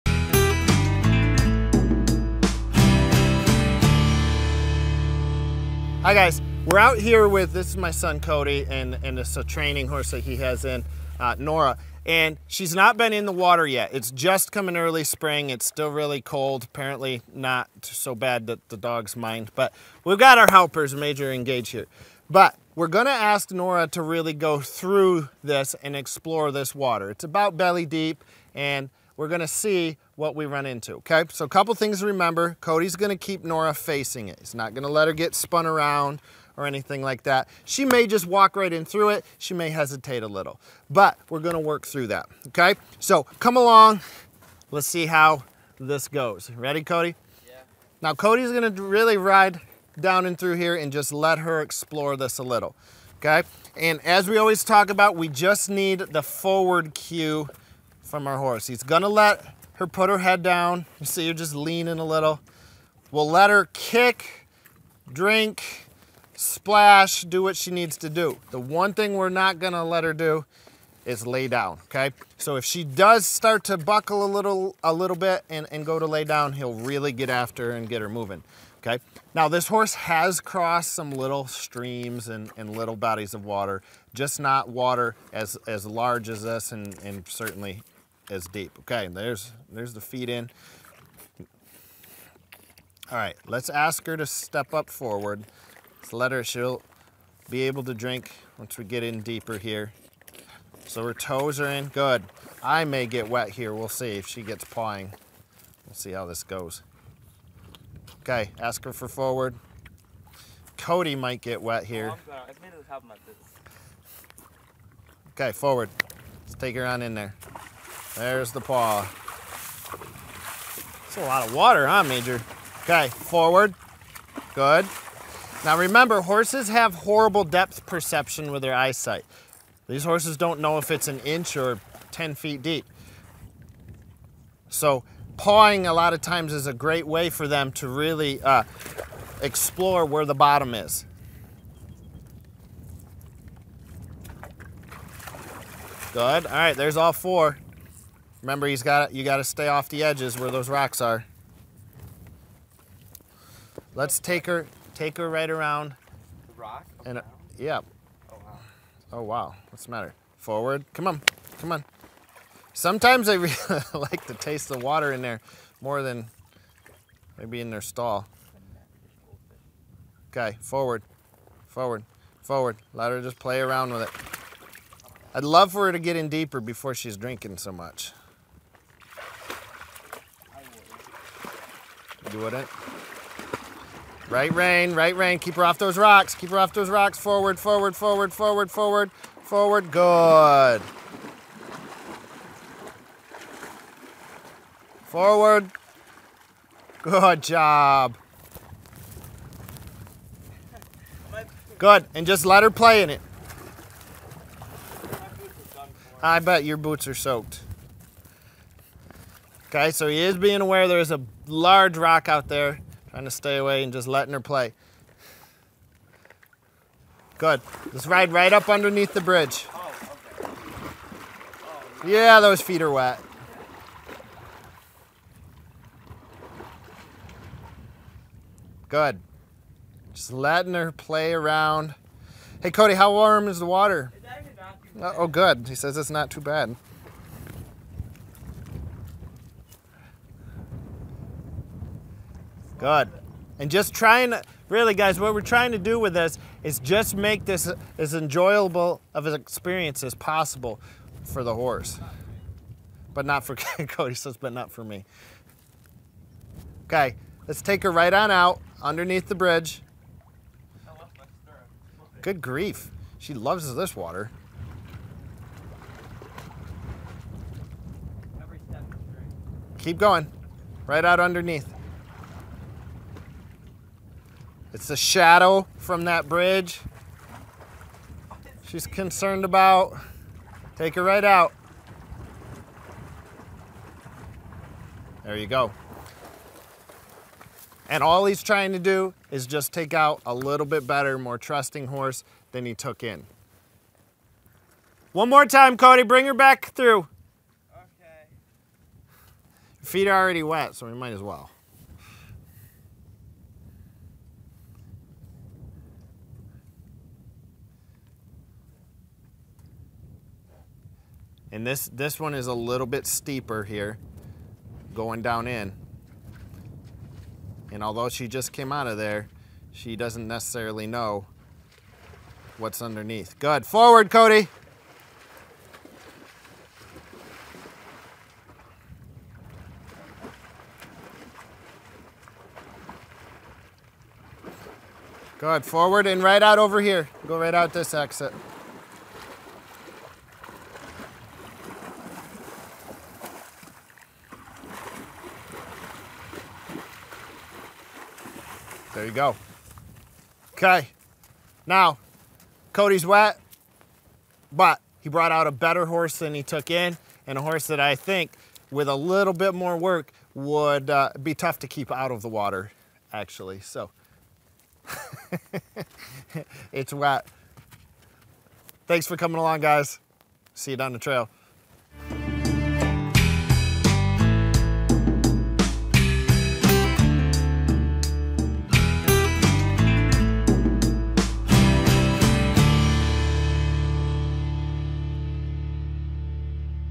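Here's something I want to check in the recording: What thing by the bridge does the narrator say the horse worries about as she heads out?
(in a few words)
A shadow.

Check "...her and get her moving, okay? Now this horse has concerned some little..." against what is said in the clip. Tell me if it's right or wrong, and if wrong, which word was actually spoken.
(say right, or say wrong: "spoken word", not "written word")
wrong: "crossed", not "concerned".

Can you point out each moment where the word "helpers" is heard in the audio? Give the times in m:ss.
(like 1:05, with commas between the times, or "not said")
0:20.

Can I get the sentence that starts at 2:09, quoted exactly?
These horses don't know if it's an inch or 10 feet deep.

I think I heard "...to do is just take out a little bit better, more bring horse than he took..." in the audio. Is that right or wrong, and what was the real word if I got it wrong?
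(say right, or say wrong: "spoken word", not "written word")
wrong: "trusting", not "bring".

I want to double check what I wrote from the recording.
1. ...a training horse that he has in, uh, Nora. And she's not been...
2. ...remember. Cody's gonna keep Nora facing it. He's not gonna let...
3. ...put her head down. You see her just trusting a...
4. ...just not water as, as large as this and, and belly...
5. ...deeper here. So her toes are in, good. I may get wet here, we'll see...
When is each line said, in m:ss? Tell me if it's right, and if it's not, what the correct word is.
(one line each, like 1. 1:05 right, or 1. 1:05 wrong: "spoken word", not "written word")
1. 0:09 right
2. 0:32 right
3. 0:59 wrong: "leaning", not "trusting"
4. 1:24 wrong: "certainly", not "belly"
5. 1:39 right.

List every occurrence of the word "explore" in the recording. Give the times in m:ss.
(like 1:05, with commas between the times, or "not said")
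0:25, 0:51, 2:19.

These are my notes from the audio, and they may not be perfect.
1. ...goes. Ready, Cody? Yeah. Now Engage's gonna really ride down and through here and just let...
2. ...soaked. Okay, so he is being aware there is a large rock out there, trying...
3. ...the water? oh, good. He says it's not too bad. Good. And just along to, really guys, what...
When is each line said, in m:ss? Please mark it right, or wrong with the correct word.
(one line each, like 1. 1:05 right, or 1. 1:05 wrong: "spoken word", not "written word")
1. 0:46 wrong: "Cody", not "Engage"
2. 3:27 right
3. 3:53 wrong: "trying", not "along".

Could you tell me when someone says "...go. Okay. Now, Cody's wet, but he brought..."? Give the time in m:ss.
5:49.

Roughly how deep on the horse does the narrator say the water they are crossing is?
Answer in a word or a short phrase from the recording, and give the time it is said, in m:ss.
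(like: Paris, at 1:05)
Belly deep, at 0:27.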